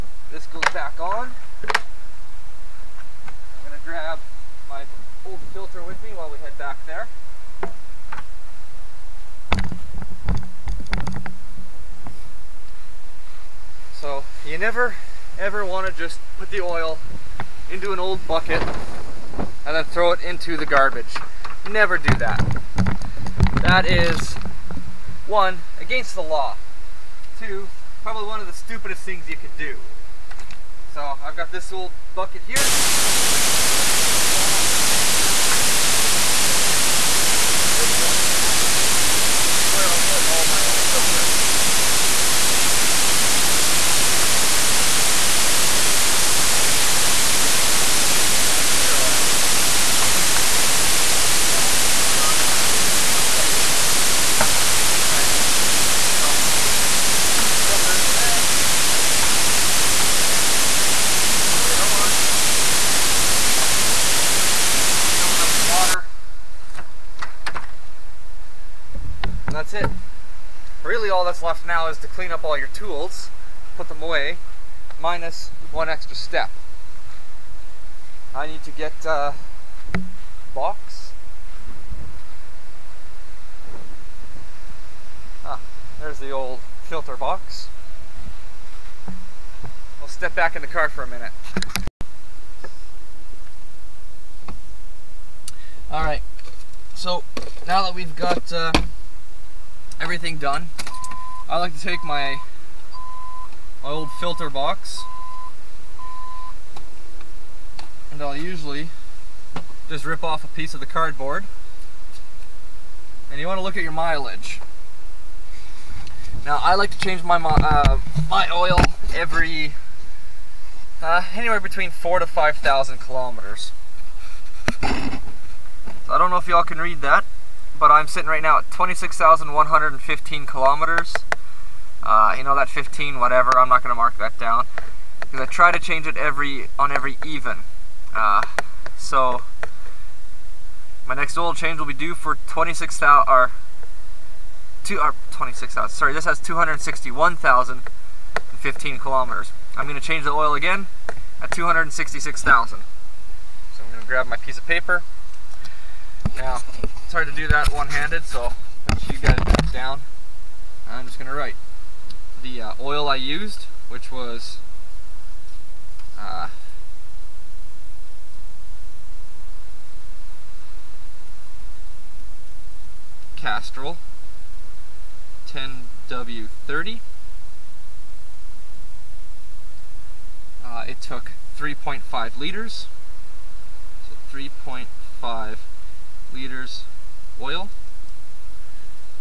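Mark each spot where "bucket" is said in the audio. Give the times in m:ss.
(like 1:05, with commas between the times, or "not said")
0:18, 0:32.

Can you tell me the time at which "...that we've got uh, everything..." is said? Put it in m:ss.
1:37.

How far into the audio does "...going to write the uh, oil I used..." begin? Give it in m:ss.
2:41.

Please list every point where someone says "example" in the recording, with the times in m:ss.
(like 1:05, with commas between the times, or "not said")
not said.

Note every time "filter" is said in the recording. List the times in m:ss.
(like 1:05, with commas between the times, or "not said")
0:05, 0:40, 0:57, 1:26, 1:44.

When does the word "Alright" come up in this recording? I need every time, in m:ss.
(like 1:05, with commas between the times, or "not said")
0:55, 1:35.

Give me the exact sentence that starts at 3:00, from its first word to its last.
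Uh, it took 3.5 liters, so 3.5 liters oil.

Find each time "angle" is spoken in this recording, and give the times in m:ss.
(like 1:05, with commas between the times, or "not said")
not said.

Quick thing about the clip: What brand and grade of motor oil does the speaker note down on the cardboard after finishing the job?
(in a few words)
Castrol 10W30.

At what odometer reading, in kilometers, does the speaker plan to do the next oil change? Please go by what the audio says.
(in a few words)
266,000.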